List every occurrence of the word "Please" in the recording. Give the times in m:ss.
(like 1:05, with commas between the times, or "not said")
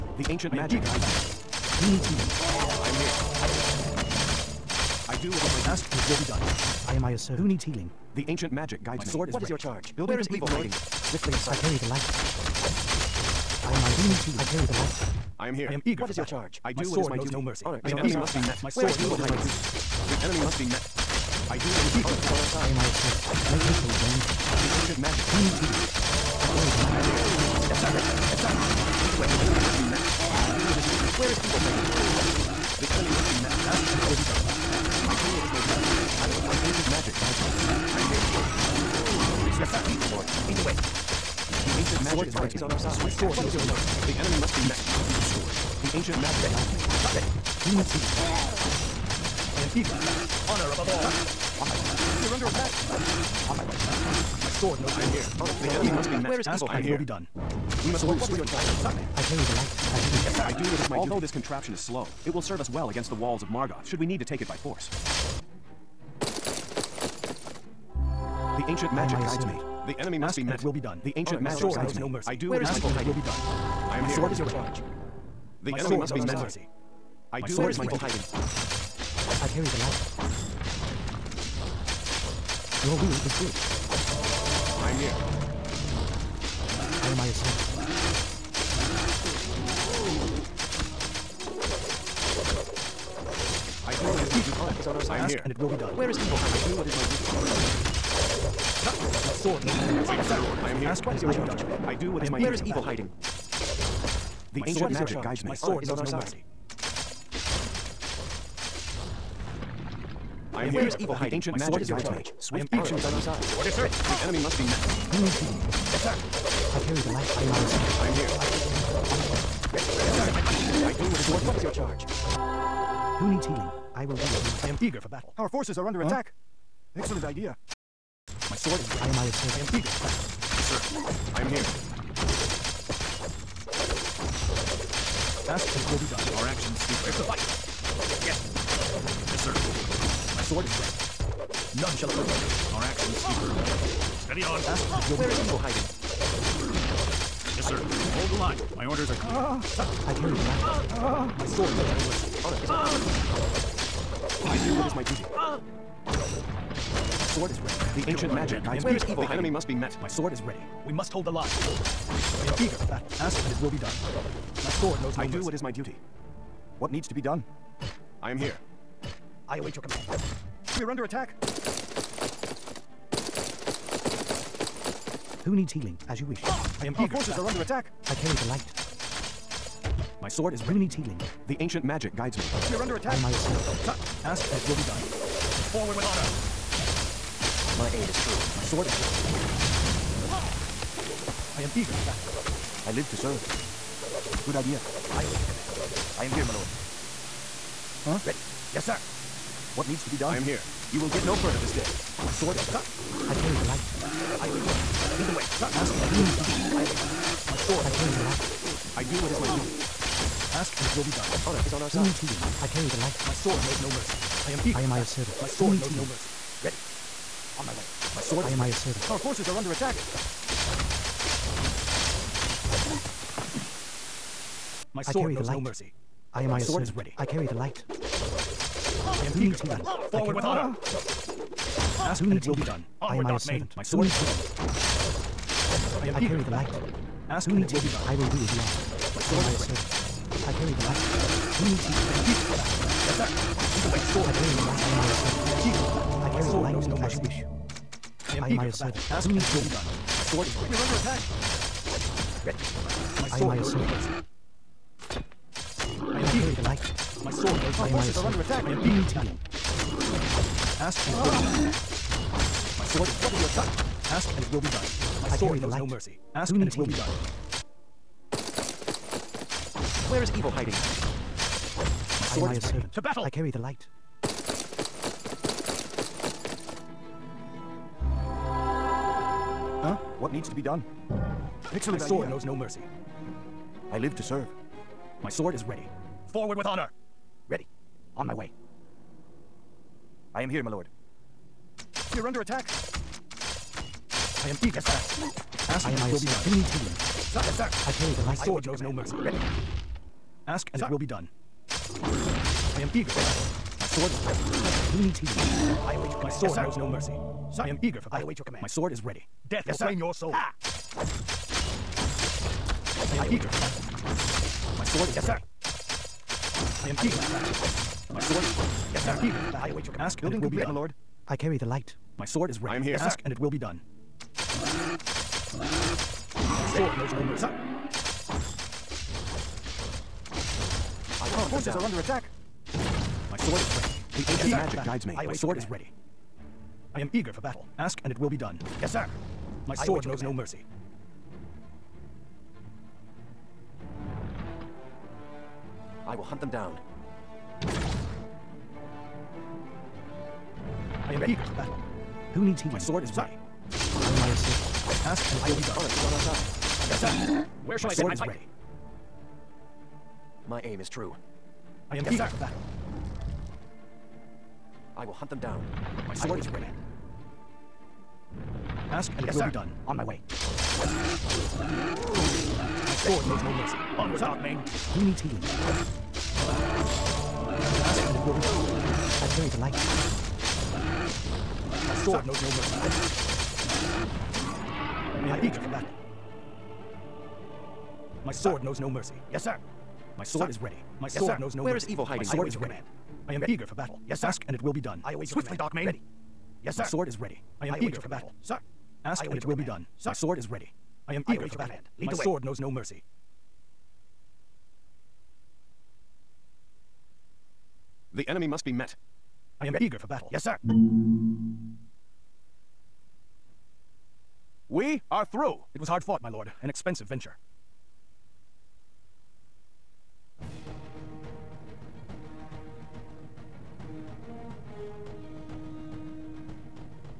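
0:39.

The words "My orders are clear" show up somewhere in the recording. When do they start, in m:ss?
2:28.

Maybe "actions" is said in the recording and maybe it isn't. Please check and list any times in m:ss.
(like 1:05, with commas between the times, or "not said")
1:52, 2:16, 2:23.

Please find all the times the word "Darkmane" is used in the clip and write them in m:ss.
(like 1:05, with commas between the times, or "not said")
6:14, 6:35.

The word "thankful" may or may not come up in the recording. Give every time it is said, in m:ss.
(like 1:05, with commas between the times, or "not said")
not said.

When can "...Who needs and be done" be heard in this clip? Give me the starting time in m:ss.
4:09.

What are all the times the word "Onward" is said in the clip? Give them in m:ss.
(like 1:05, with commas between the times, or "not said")
3:53, 6:13.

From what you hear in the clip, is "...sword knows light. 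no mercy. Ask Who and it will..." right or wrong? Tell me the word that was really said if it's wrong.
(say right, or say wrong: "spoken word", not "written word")
right.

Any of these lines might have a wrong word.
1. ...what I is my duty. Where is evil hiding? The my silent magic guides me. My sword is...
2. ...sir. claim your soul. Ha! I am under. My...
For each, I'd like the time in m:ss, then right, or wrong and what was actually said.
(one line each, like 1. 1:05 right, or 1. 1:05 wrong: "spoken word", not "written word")
1. 1:42 wrong: "ancient", not "silent"
2. 5:09 wrong: "eager", not "under".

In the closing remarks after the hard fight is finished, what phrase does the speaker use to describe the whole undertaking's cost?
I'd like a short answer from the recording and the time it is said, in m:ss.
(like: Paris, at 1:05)
An expensive venture, at 6:56.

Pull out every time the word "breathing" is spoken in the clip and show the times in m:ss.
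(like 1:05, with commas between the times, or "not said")
not said.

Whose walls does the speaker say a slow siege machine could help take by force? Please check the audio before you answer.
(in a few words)
Margoth.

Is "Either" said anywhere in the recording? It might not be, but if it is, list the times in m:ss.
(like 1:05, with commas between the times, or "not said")
0:40, 4:03.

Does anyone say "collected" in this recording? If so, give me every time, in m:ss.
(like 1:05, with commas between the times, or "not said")
not said.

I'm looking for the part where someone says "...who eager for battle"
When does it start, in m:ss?
3:49.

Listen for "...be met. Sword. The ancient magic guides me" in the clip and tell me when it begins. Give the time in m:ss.
0:44.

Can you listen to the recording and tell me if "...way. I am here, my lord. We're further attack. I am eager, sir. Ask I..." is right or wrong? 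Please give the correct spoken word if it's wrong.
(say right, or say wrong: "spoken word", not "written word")
wrong: "under", not "further".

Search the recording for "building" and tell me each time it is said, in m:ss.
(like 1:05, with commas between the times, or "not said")
0:09, 5:20.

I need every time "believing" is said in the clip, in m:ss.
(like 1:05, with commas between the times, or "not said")
not said.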